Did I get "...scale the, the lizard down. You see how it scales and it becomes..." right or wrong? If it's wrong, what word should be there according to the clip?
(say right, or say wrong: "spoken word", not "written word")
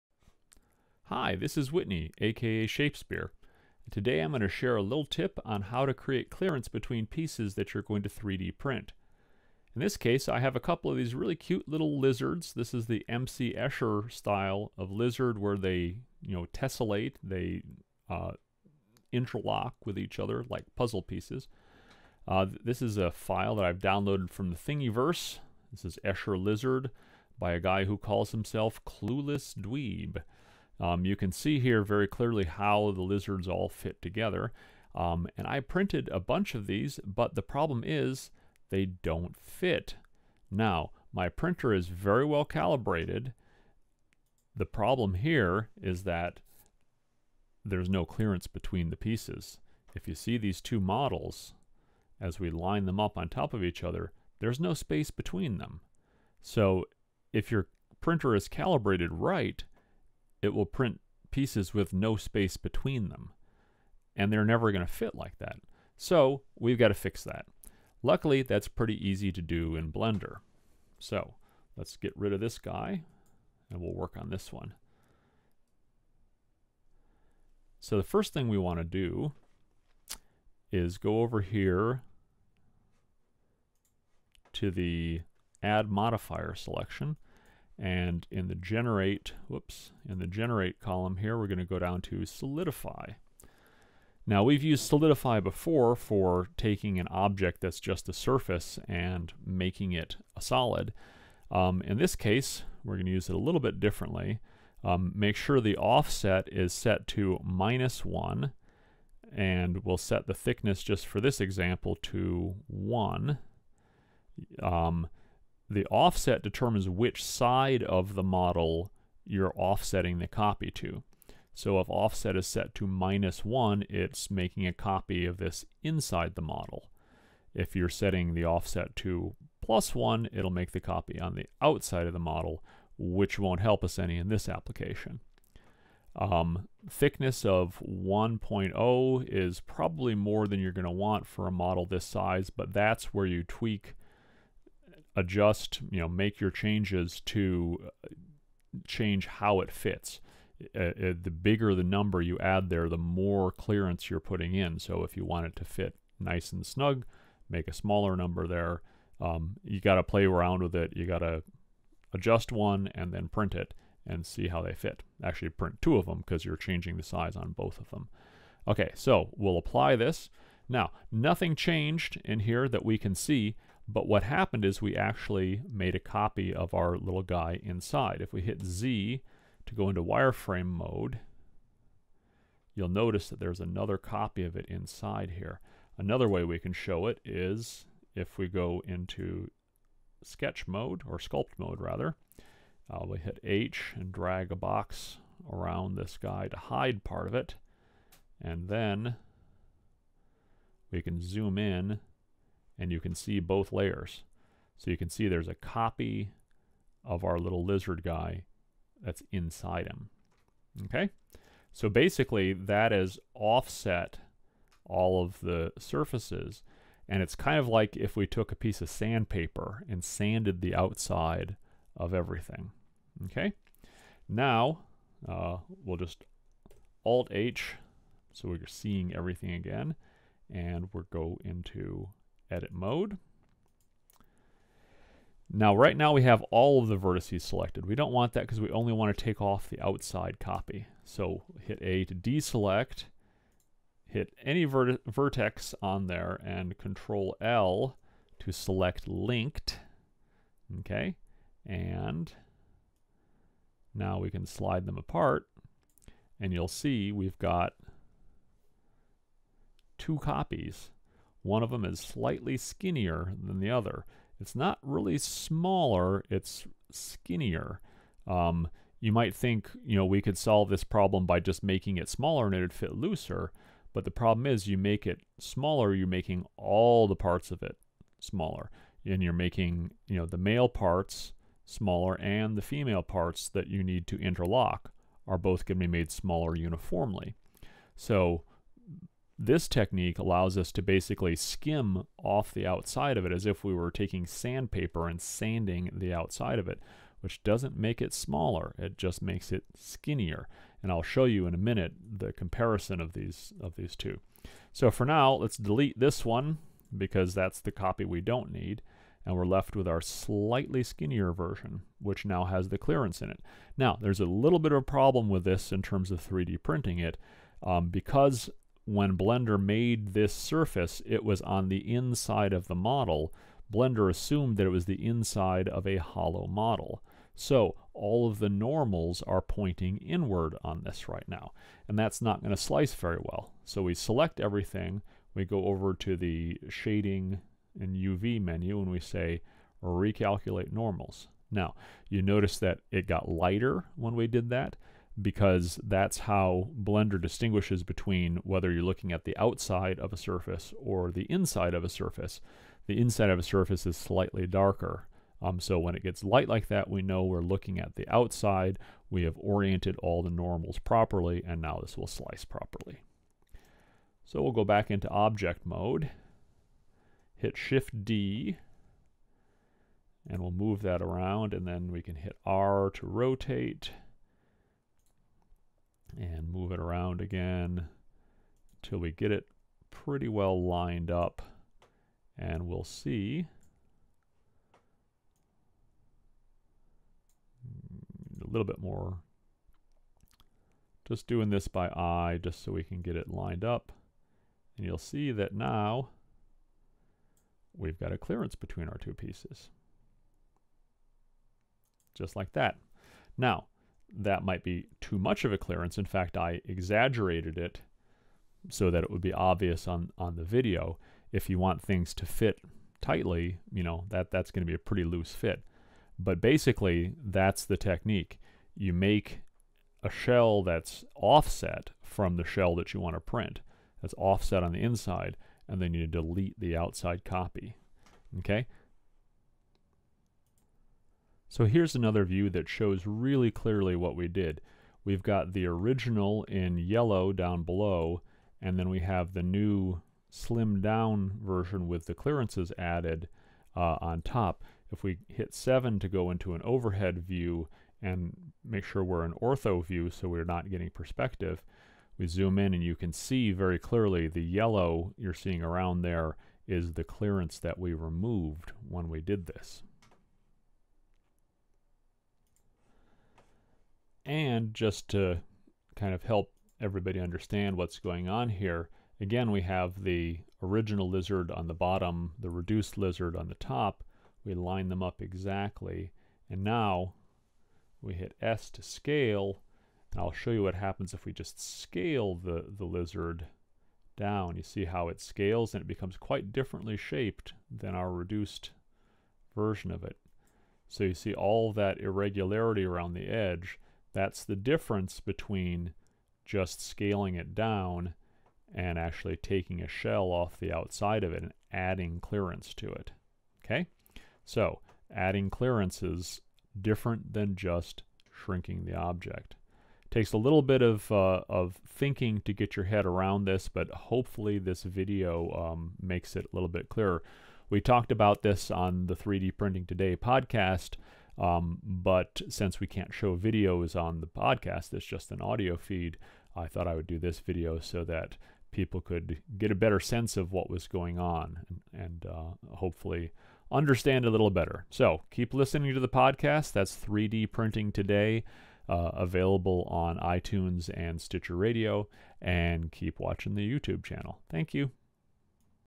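right.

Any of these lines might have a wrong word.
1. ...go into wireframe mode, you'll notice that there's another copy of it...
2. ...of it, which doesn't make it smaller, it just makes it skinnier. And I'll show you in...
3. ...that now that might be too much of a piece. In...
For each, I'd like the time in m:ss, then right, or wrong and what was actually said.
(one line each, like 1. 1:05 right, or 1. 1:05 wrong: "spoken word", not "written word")
1. 2:59 right
2. 4:56 right
3. 6:42 wrong: "clearance", not "piece".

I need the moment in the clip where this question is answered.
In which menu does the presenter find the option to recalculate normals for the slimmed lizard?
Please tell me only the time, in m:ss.
5:36.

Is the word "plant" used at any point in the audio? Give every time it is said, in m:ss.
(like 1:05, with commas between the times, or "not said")
not said.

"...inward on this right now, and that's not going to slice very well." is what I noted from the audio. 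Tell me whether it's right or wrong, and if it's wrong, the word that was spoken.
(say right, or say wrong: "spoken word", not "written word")
right.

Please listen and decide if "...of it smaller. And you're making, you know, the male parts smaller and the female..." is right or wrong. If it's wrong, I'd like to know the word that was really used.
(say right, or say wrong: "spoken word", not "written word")
right.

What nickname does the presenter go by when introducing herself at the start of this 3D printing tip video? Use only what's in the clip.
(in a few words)
Shapespeare.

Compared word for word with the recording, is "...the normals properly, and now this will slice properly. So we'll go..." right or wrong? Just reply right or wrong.
right.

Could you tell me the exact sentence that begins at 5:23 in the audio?
Blender assumed that it was the inside of a hollow model.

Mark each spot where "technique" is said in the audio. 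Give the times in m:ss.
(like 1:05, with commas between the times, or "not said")
4:49, 6:57.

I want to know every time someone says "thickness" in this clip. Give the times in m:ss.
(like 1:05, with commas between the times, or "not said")
1:50, 2:16.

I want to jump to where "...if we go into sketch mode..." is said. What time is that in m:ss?
3:08.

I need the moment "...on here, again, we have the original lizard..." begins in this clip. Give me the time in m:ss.
7:48.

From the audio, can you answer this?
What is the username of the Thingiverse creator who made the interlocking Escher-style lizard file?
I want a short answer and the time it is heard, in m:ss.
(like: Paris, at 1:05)
Clueless Dweeb, at 0:28.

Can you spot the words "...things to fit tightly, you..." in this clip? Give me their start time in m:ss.
6:51.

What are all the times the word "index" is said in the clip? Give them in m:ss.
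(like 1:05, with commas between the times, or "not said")
not said.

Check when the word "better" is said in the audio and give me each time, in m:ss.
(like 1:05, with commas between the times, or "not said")
8:49, 8:54.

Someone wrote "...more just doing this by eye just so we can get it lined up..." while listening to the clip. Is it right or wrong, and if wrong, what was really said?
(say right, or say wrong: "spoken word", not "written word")
right.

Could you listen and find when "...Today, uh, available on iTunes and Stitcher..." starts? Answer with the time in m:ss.
8:57.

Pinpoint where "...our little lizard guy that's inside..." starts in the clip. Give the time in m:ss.
3:27.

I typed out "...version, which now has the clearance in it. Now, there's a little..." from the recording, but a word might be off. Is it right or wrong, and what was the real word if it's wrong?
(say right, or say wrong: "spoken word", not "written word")
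right.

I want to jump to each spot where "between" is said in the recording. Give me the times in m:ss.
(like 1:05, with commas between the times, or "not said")
0:06, 0:48, 0:55, 1:02, 5:47, 6:38, 8:15.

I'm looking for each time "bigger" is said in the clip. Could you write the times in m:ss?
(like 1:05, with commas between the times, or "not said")
2:31.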